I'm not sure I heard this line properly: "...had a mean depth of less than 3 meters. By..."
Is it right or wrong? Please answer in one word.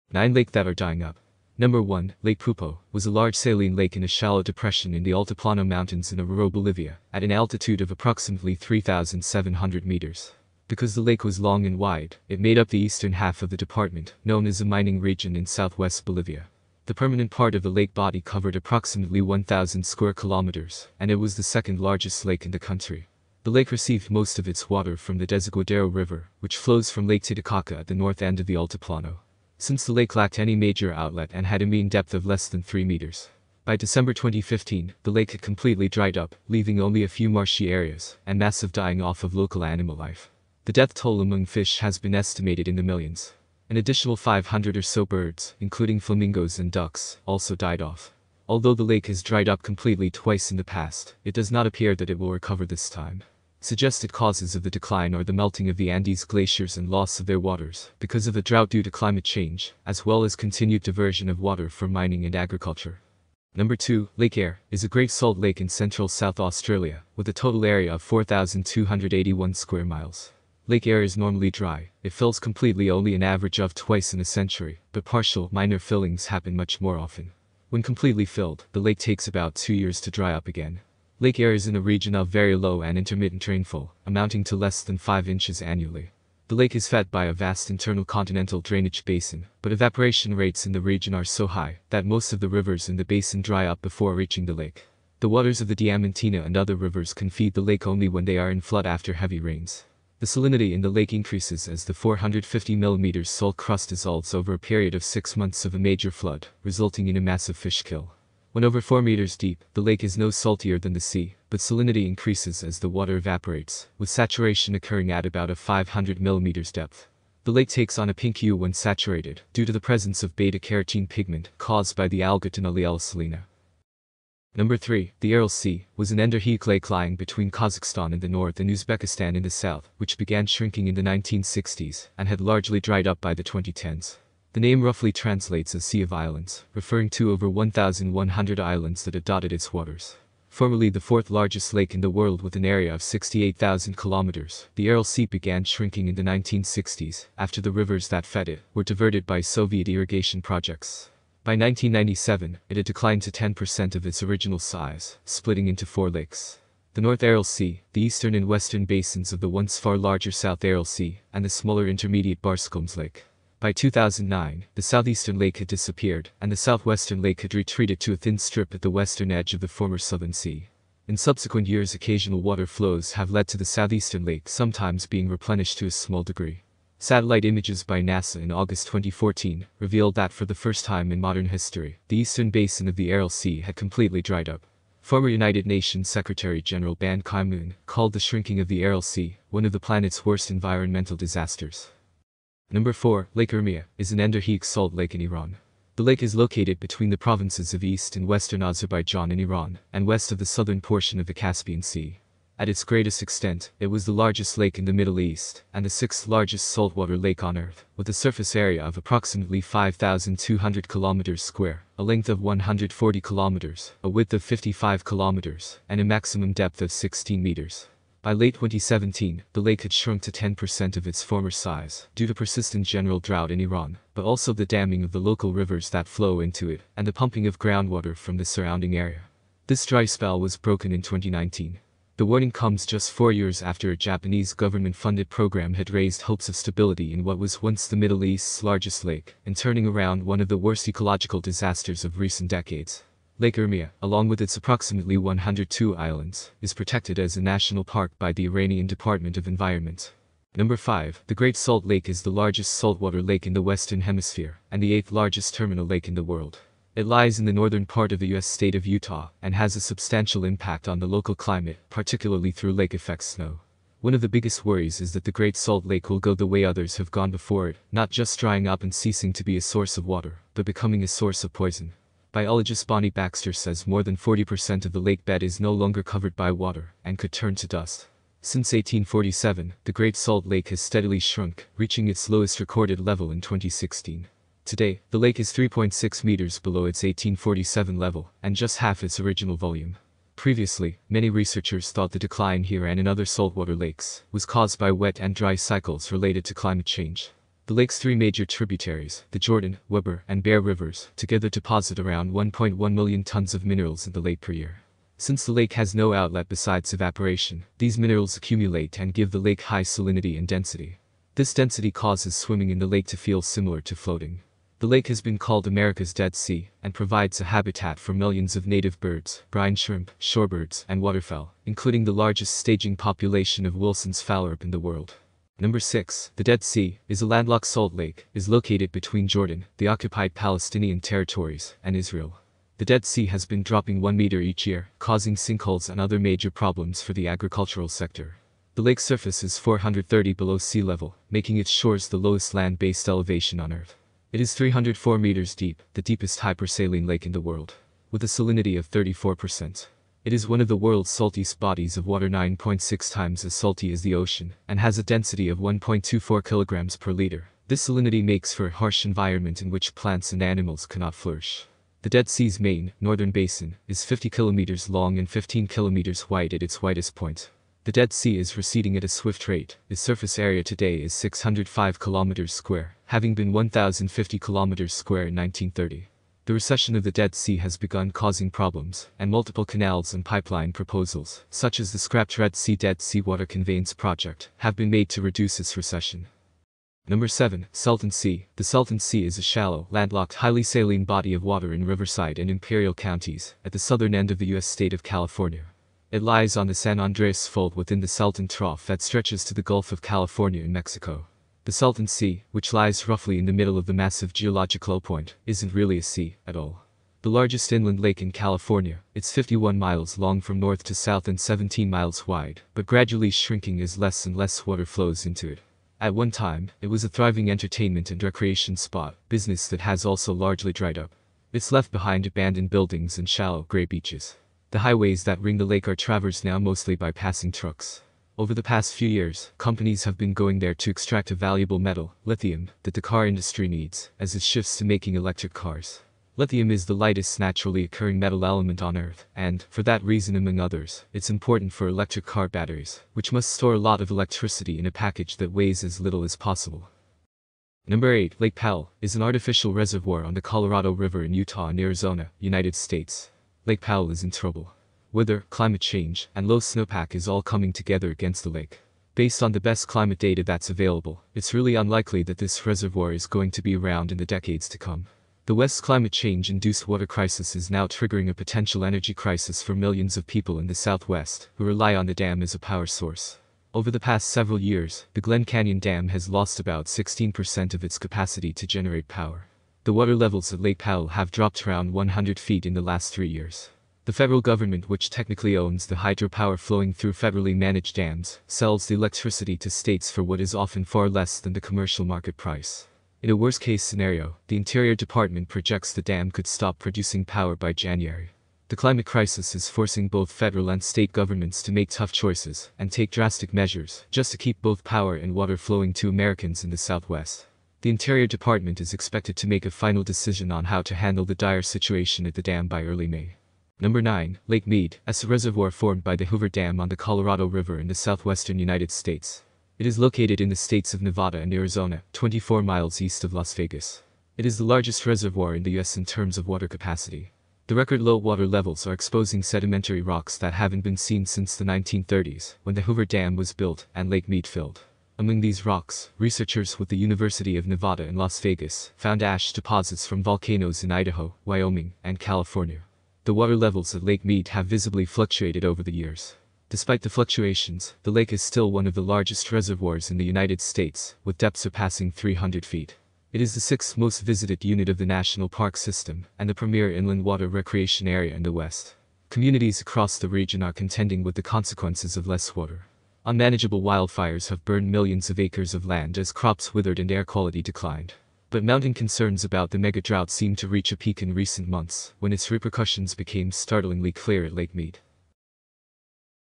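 right.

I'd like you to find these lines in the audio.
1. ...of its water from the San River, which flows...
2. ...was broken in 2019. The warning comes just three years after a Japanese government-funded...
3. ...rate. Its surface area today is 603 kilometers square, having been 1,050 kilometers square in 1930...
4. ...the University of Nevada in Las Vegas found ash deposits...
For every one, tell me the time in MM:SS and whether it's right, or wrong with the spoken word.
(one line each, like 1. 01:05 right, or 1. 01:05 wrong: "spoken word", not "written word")
1. 00:24 wrong: "Desaguadero", not "San"
2. 03:50 wrong: "four", not "three"
3. 06:09 wrong: "605", not "603"
4. 08:56 right.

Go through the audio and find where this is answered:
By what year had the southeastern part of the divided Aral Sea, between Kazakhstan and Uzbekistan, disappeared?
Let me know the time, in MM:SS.
02:43.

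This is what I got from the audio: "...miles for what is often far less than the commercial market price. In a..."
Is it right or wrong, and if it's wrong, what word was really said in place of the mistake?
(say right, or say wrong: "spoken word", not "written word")
wrong: "states", not "miles".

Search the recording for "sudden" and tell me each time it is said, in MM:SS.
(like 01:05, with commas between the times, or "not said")
not said.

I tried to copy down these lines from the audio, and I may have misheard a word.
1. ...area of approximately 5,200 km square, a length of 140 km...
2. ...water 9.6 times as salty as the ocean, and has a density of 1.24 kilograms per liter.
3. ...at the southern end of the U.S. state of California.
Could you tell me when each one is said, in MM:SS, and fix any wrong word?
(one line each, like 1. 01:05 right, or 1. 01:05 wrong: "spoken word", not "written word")
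1. 03:28 right
2. 05:52 right
3. 06:33 right.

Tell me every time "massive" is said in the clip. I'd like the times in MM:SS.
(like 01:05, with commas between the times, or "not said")
00:38, 01:47, 06:43.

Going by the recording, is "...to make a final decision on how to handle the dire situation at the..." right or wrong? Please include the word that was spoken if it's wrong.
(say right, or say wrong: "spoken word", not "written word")
right.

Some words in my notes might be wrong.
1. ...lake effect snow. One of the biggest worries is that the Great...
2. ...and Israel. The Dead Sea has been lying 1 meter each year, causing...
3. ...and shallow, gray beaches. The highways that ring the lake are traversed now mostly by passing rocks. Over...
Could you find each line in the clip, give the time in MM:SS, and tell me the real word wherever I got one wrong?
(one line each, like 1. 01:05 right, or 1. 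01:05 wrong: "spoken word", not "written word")
1. 04:22 right
2. 05:31 wrong: "dropping", not "lying"
3. 07:03 wrong: "trucks", not "rocks".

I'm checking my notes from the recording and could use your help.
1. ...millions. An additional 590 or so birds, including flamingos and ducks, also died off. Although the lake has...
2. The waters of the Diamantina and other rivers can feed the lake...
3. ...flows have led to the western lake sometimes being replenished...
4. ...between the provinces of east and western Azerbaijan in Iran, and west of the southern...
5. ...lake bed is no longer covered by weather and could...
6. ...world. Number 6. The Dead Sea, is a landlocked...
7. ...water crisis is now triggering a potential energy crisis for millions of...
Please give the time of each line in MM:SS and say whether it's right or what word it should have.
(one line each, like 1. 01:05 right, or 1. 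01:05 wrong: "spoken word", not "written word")
1. 00:42 wrong: "500", not "590"
2. 01:35 right
3. 02:52 wrong: "southeastern", not "western"
4. 03:16 right
5. 04:35 wrong: "water", not "weather"
6. 05:24 right
7. 07:46 right.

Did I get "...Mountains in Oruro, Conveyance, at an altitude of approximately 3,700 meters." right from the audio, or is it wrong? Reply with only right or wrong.
wrong.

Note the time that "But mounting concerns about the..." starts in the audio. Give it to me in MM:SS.
09:28.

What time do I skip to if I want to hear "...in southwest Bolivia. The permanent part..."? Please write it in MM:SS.
00:15.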